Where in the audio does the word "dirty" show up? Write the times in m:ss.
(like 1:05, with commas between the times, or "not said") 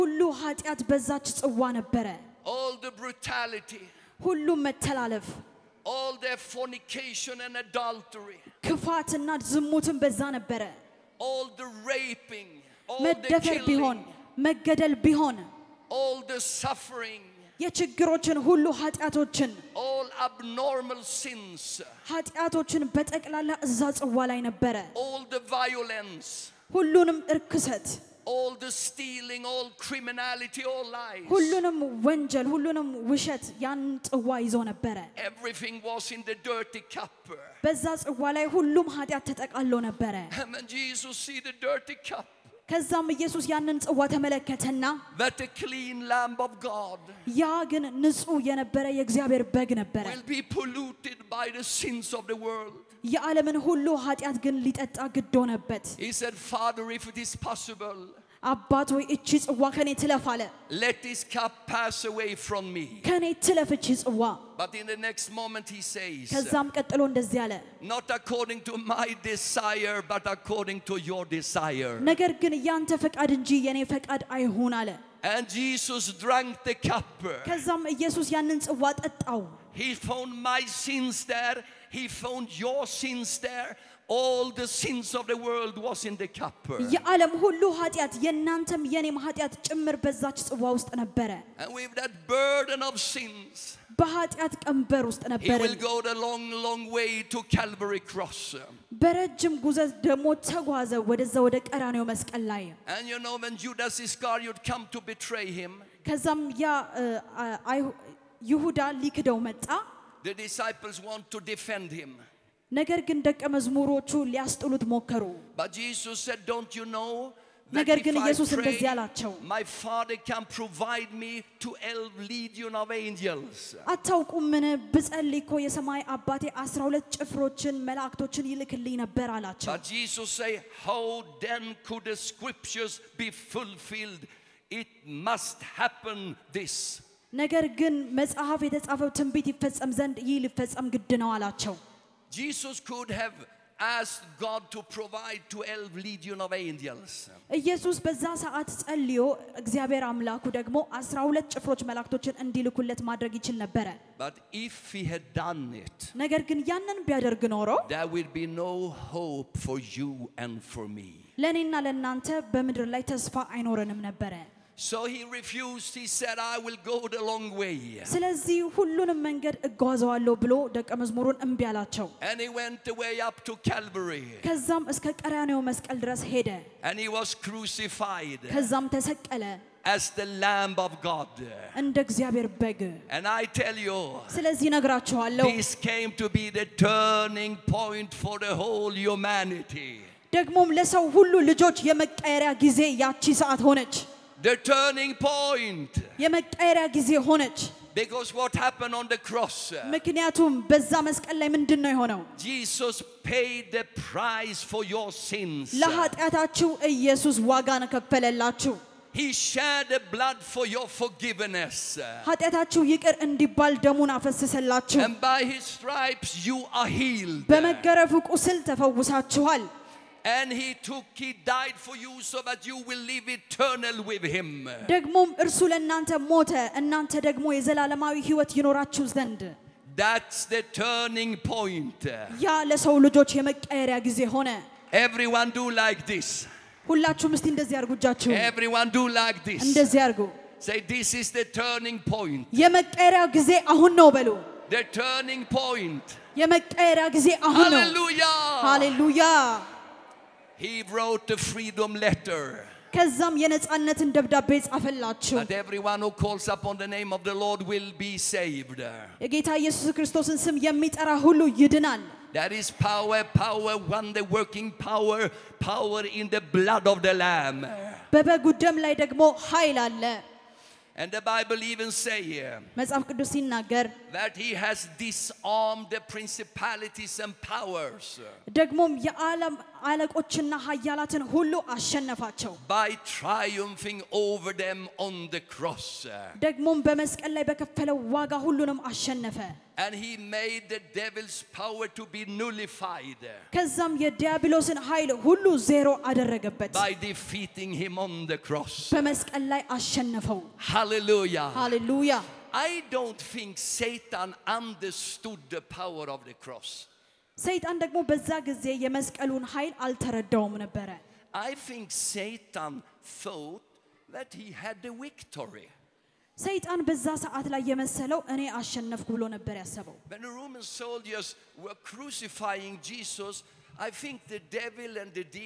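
0:36, 0:41.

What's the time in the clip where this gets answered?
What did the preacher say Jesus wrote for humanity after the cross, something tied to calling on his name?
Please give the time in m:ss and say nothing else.
4:11.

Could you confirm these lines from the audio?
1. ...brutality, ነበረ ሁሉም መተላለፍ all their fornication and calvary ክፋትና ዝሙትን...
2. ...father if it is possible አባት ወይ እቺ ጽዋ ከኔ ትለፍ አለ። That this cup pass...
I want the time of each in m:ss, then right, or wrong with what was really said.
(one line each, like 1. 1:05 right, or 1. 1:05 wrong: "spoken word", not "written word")
1. 0:03 wrong: "adultery", not "calvary"
2. 0:56 wrong: "Let", not "That".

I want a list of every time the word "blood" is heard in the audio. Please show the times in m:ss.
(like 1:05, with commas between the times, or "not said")
3:30, 4:26.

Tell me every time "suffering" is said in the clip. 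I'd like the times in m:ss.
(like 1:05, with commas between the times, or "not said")
0:16.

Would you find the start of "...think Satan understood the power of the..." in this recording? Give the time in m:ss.
5:03.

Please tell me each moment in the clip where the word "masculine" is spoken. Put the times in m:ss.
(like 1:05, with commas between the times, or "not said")
not said.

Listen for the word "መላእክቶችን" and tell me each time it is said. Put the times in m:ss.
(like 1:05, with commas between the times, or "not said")
2:07, 2:31.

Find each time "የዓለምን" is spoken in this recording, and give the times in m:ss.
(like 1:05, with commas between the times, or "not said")
0:53.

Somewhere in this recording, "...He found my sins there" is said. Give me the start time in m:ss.
1:19.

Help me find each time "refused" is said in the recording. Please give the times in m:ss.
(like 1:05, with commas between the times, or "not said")
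2:45.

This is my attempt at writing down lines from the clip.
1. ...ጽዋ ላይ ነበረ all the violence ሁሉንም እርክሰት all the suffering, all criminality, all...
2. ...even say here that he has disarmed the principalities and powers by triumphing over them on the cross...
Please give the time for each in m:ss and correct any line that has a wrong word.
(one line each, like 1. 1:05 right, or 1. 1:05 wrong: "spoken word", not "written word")
1. 0:23 wrong: "stealing", not "suffering"
2. 4:31 right.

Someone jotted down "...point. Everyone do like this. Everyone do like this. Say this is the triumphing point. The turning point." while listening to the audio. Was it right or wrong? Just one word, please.
wrong.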